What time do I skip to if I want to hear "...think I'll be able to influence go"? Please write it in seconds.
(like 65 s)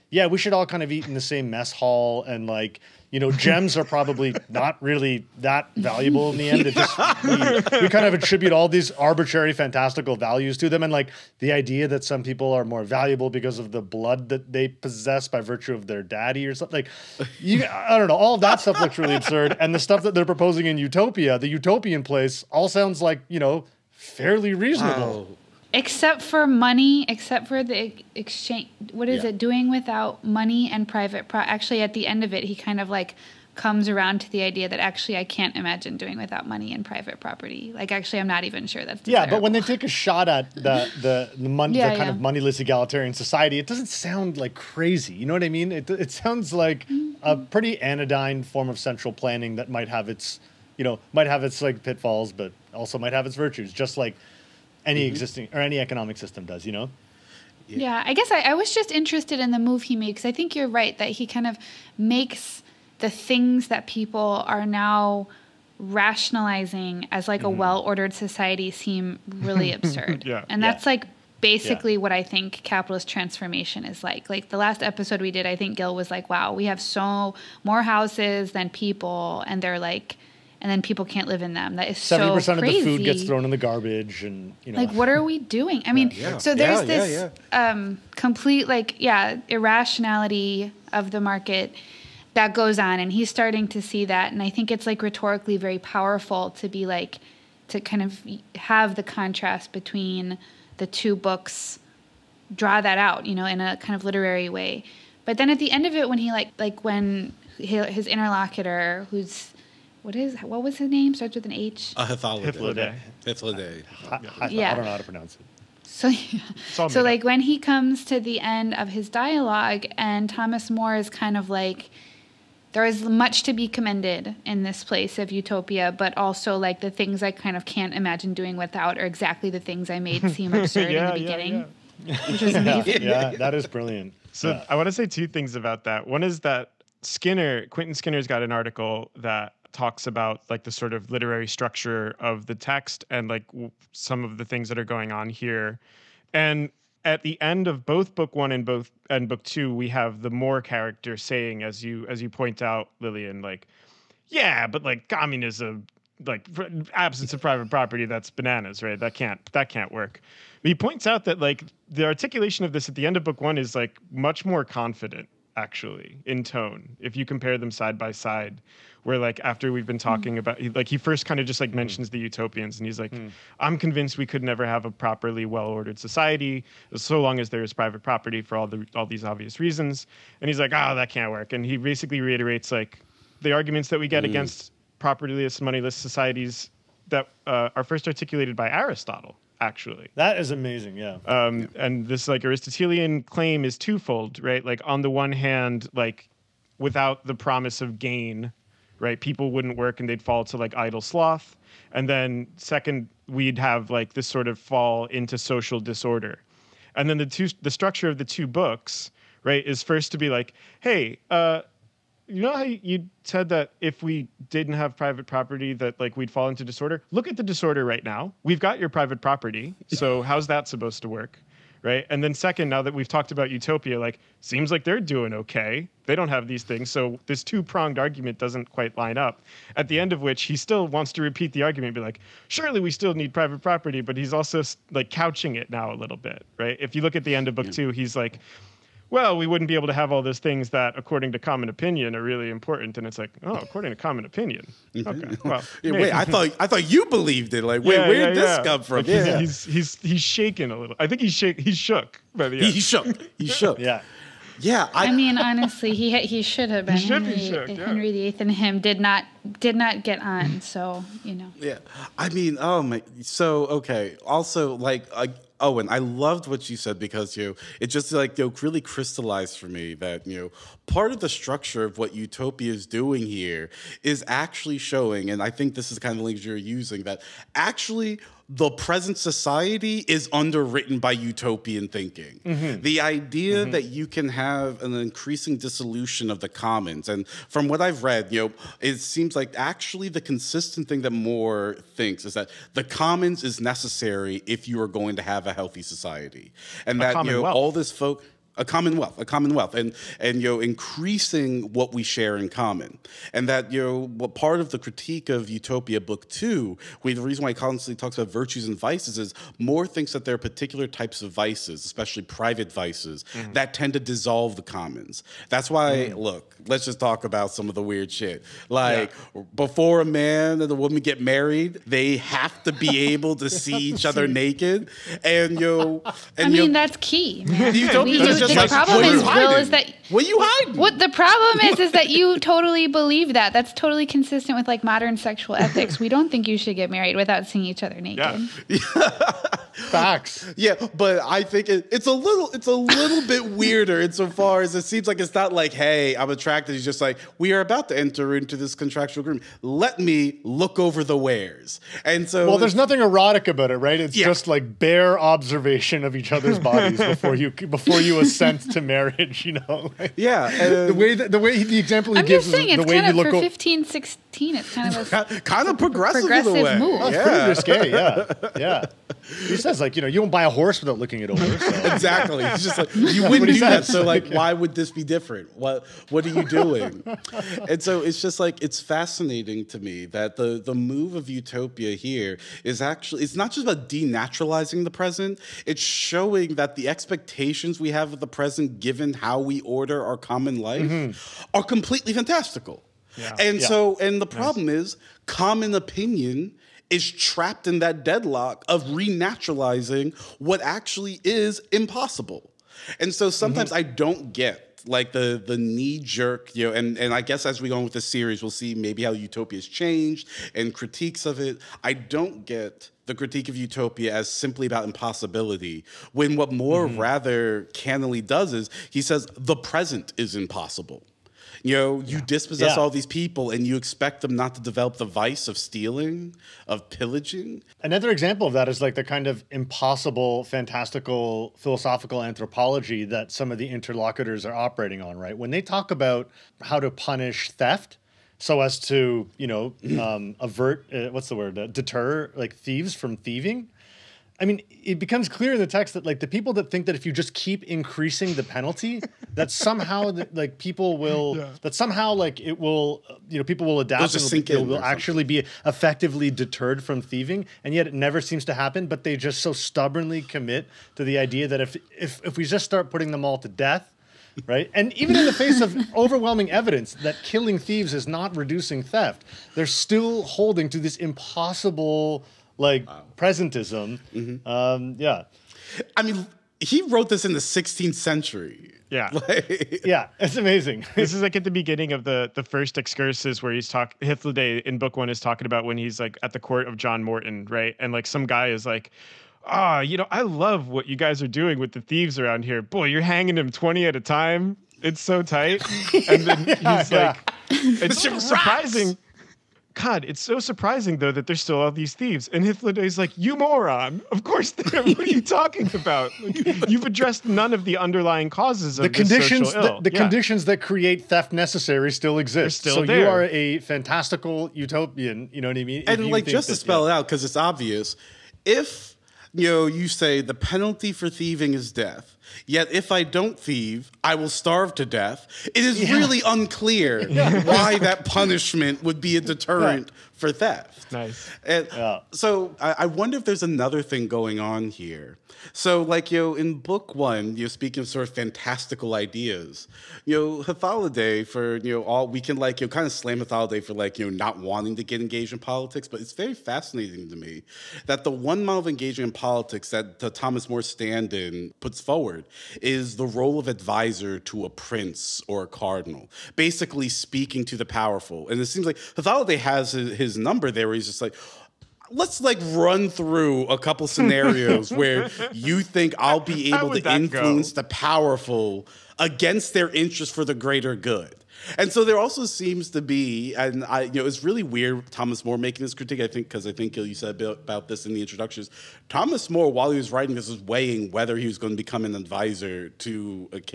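565 s.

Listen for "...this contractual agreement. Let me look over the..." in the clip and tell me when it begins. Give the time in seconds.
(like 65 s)
348 s.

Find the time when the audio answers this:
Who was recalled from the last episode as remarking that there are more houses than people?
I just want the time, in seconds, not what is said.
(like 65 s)
75 s.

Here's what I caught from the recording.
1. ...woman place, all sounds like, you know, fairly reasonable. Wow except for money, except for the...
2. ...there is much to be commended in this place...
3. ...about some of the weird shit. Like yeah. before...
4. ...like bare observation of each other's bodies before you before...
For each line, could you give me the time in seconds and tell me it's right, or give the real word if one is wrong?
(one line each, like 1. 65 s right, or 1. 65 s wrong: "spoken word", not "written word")
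1. 21 s wrong: "utopian", not "woman"
2. 122 s right
3. 317 s right
4. 354 s right.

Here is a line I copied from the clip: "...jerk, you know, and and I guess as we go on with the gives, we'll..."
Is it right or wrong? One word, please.
wrong.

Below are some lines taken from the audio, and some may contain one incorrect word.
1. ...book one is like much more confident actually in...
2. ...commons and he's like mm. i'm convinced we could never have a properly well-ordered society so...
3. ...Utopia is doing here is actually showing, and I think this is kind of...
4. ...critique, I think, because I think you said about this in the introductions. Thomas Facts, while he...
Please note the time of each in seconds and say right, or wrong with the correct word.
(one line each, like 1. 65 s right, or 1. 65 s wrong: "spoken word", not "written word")
1. 163 s right
2. 172 s wrong: "utopians", not "commons"
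3. 272 s right
4. 575 s wrong: "More", not "Facts".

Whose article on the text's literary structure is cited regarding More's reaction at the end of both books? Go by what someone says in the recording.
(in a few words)
Quentin Skinner.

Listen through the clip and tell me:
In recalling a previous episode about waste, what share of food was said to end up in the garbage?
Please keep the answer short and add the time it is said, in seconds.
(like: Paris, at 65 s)
70%, at 81 s.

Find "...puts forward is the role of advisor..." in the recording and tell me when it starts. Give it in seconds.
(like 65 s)
551 s.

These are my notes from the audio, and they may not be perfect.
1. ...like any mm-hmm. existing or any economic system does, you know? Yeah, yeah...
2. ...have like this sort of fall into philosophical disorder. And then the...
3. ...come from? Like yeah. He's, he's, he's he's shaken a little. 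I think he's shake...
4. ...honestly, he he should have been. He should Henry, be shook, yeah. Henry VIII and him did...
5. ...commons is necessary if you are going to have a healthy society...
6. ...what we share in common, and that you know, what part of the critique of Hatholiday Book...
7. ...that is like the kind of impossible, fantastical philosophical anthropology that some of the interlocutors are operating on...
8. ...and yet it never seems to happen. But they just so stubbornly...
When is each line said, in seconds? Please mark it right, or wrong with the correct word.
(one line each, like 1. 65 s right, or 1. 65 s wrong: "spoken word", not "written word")
1. 53 s right
2. 203 s wrong: "social", not "philosophical"
3. 248 s right
4. 255 s right
5. 292 s right
6. 301 s wrong: "Utopia", not "Hatholiday"
7. 428 s right
8. 457 s right.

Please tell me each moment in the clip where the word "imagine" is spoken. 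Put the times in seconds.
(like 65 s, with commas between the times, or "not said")
35 s, 127 s.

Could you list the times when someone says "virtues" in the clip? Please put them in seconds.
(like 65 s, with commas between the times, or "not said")
15 s, 53 s, 308 s.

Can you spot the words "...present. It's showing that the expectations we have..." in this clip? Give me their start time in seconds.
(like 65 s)
384 s.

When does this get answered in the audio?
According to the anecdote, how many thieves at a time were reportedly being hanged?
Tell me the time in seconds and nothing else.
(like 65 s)
493 s.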